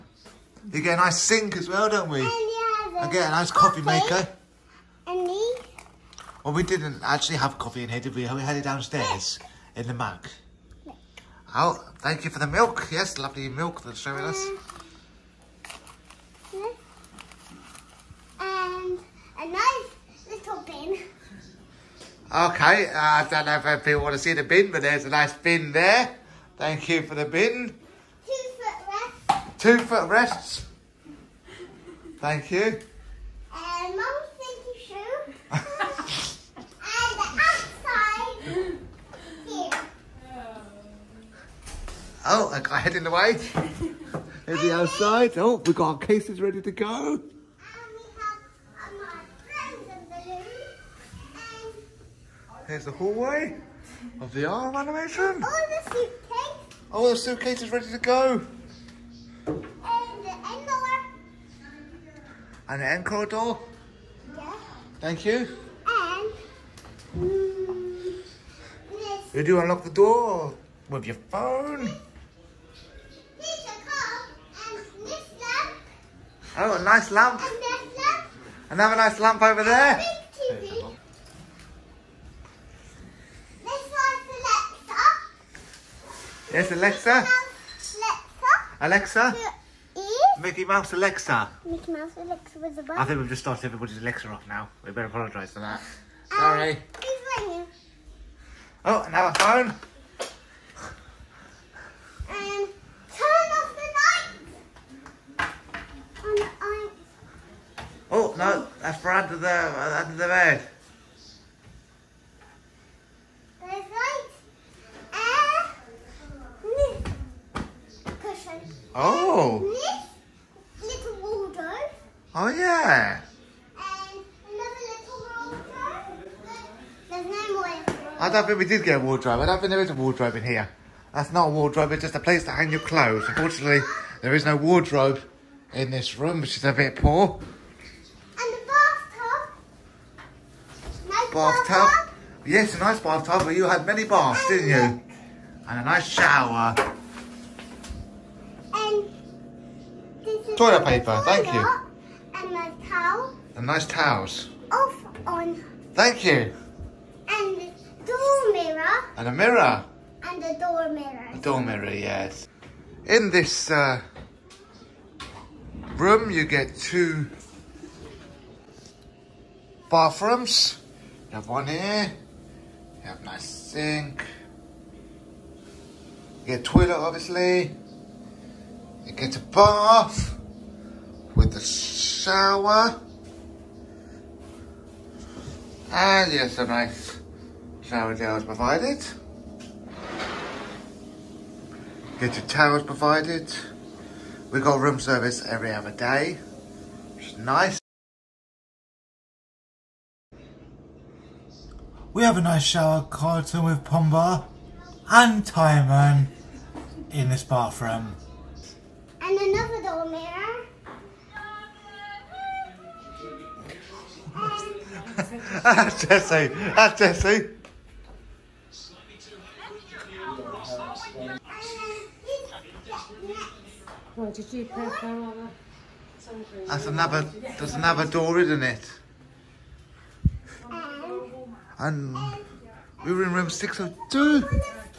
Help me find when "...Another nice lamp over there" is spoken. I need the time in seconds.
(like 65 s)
78 s.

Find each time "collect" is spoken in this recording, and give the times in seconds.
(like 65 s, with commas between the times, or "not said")
not said.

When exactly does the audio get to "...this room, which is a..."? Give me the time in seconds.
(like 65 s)
135 s.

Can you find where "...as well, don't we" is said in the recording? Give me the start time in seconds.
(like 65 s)
1 s.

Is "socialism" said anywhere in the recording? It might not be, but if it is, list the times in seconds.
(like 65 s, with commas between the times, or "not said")
not said.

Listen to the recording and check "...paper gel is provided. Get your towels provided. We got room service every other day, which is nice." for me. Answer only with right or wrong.
wrong.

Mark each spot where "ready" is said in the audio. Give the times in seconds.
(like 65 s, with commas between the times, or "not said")
46 s, 57 s.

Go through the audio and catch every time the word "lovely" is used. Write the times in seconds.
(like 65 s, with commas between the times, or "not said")
13 s.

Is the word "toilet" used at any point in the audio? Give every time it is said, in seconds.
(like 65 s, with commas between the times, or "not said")
150 s, 176 s.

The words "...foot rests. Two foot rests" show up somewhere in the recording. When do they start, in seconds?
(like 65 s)
28 s.